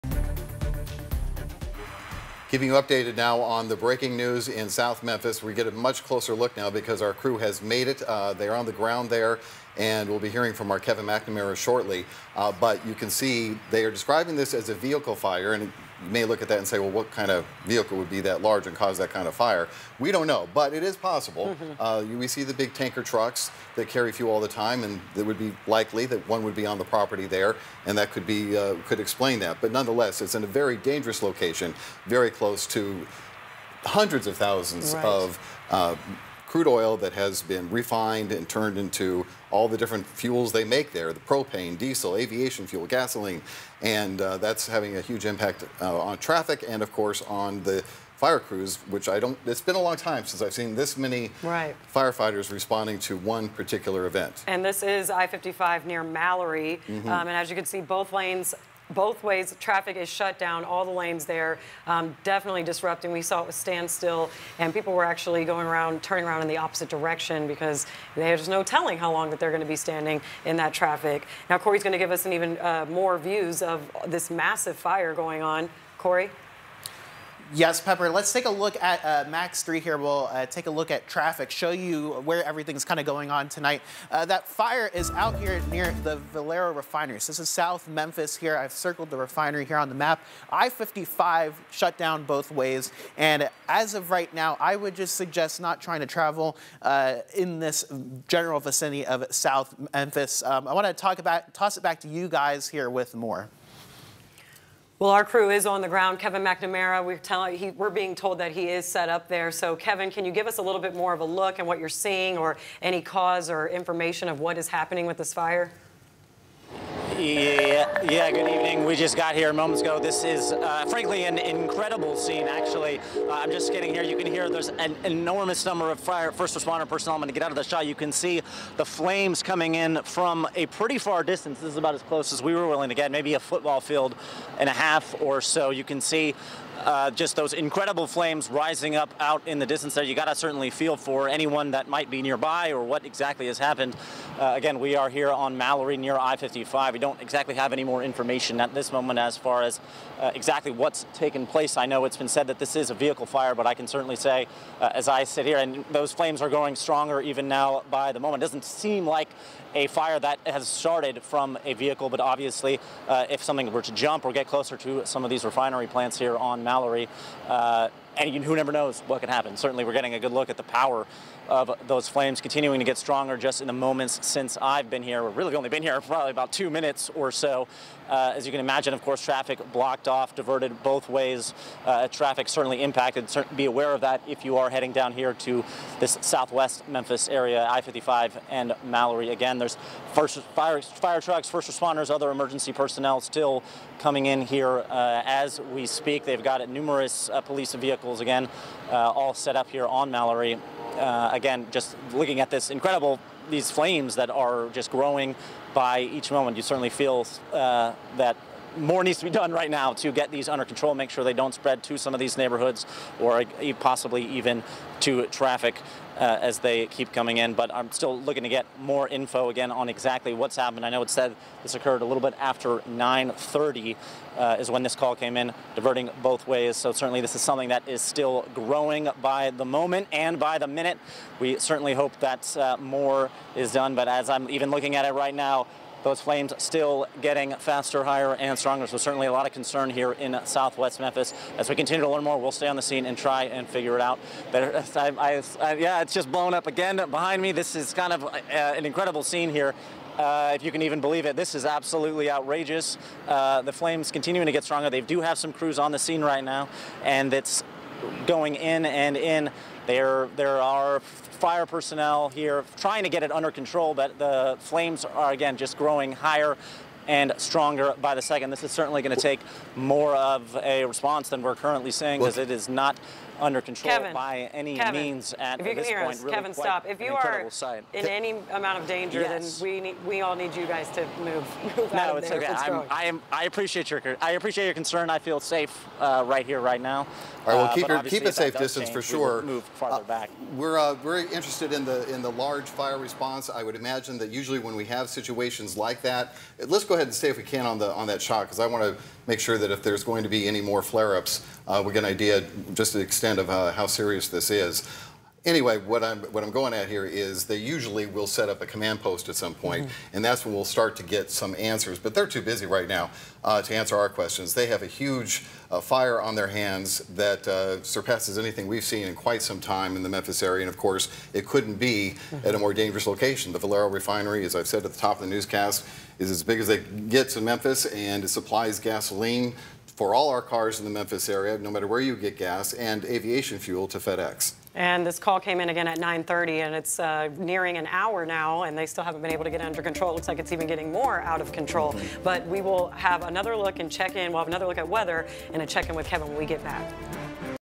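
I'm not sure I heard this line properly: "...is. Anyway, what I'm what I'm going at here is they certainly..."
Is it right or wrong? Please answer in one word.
wrong.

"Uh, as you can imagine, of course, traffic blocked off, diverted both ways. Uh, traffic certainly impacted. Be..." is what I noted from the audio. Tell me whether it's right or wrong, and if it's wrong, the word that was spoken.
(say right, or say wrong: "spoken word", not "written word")
right.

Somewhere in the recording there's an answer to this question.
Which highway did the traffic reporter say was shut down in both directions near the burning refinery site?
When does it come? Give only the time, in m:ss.
1:30.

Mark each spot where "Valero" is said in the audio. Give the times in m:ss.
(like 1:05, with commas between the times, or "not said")
1:26, 5:23.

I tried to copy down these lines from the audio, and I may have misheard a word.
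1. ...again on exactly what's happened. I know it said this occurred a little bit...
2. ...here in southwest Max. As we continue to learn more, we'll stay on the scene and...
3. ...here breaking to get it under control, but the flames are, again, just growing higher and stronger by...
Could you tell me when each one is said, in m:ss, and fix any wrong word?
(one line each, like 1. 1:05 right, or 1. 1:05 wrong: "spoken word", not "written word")
1. 3:39 right
2. 3:59 wrong: "Memphis", not "Max"
3. 4:22 wrong: "trying", not "breaking".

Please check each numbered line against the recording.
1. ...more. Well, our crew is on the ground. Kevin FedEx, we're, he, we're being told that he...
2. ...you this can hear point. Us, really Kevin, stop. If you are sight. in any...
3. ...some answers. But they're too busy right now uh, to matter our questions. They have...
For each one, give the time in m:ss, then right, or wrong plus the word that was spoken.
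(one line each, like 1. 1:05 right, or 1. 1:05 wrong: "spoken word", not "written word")
1. 1:43 wrong: "McNamara", not "FedEx"
2. 4:35 right
3. 5:11 wrong: "answer", not "matter".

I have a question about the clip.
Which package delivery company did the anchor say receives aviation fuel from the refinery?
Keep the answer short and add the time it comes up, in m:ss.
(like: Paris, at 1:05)
FedEx, at 5:33.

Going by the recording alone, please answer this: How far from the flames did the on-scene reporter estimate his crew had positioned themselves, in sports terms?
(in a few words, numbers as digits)
A football field and a half.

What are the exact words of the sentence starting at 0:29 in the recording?
But nonetheless, it's in a very dangerous location, very close to hundreds of thousands right.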